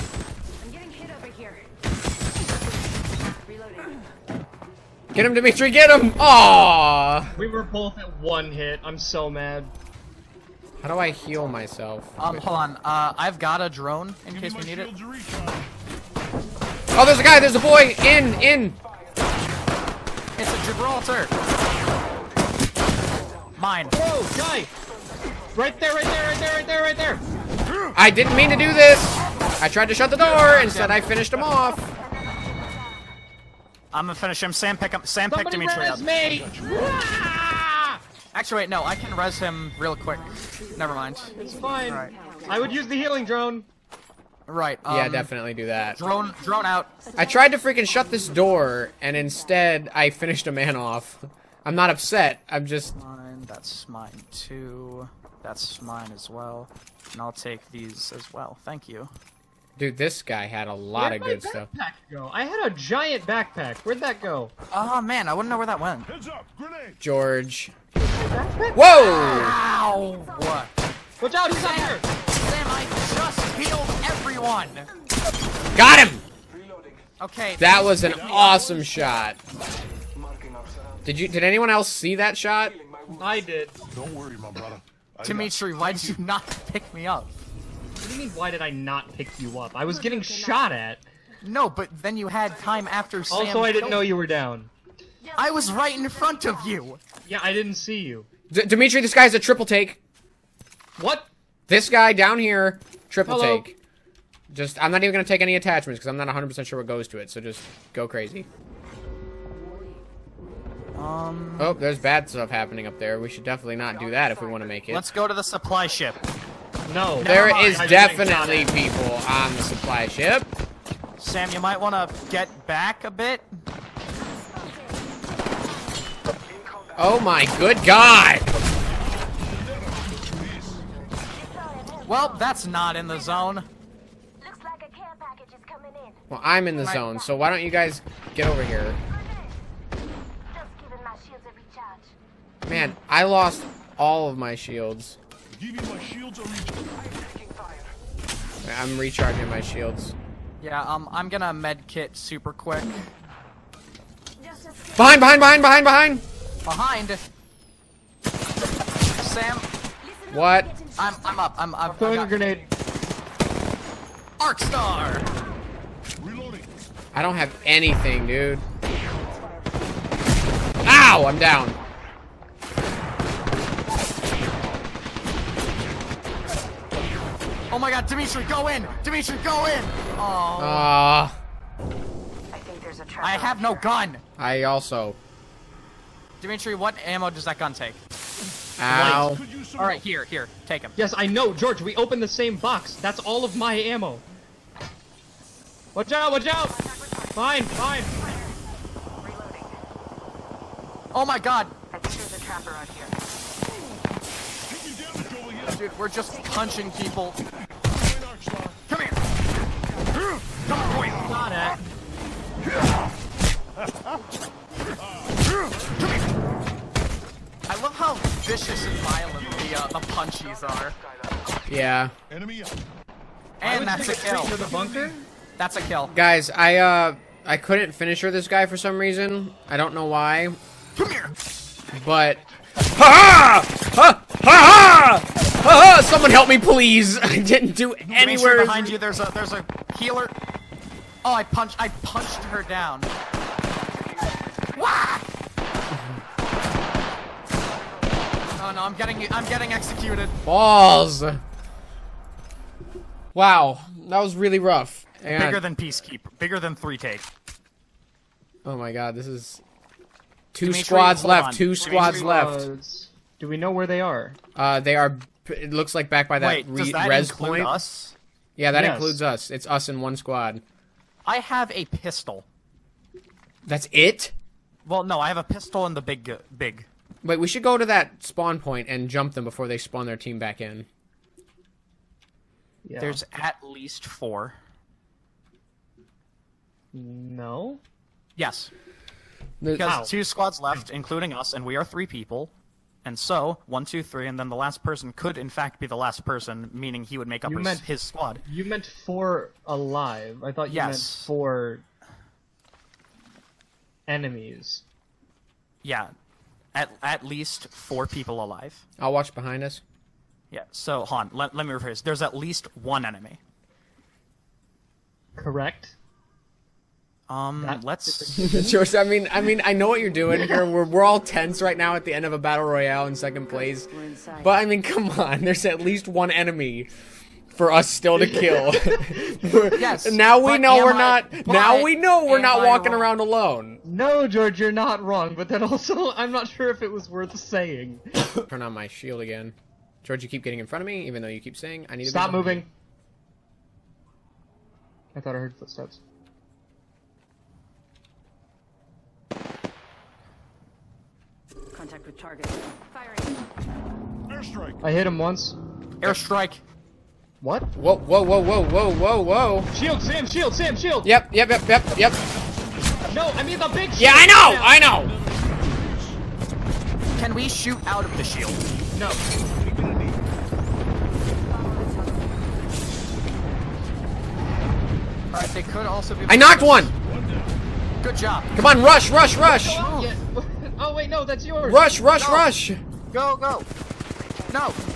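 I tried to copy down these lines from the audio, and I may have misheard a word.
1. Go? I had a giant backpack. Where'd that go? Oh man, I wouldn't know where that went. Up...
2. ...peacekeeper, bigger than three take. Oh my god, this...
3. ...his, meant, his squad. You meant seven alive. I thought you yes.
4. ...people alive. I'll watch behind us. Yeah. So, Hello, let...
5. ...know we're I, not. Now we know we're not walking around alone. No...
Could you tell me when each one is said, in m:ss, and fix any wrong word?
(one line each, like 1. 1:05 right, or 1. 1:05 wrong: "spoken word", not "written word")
1. 1:02 right
2. 4:15 right
3. 4:57 wrong: "four", not "seven"
4. 5:08 wrong: "Han", not "Hello"
5. 5:30 right.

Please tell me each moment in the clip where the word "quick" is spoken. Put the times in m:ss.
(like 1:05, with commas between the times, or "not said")
0:39, 2:32.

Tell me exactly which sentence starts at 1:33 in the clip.
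Also, I didn't know you were down.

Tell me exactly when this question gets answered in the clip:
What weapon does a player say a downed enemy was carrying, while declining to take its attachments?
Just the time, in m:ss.
1:39.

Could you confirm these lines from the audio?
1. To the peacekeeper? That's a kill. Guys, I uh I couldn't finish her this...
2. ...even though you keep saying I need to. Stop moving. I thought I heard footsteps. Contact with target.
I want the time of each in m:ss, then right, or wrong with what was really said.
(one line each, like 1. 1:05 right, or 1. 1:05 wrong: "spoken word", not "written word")
1. 3:44 wrong: "bunker", not "peacekeeper"
2. 5:41 right.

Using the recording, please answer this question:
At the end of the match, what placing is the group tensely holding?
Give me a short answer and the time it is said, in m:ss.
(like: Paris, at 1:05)
second place, at 5:23.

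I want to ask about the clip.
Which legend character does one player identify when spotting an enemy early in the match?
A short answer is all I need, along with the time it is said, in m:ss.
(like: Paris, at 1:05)
Gibraltar, at 0:20.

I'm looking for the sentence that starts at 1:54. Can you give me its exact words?
Let's go to the supply ship.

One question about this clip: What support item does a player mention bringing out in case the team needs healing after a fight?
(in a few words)
healing drone.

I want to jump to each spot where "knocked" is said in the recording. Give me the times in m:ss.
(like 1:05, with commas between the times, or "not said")
6:16.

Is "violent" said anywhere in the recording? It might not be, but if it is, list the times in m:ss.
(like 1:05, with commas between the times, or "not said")
3:38.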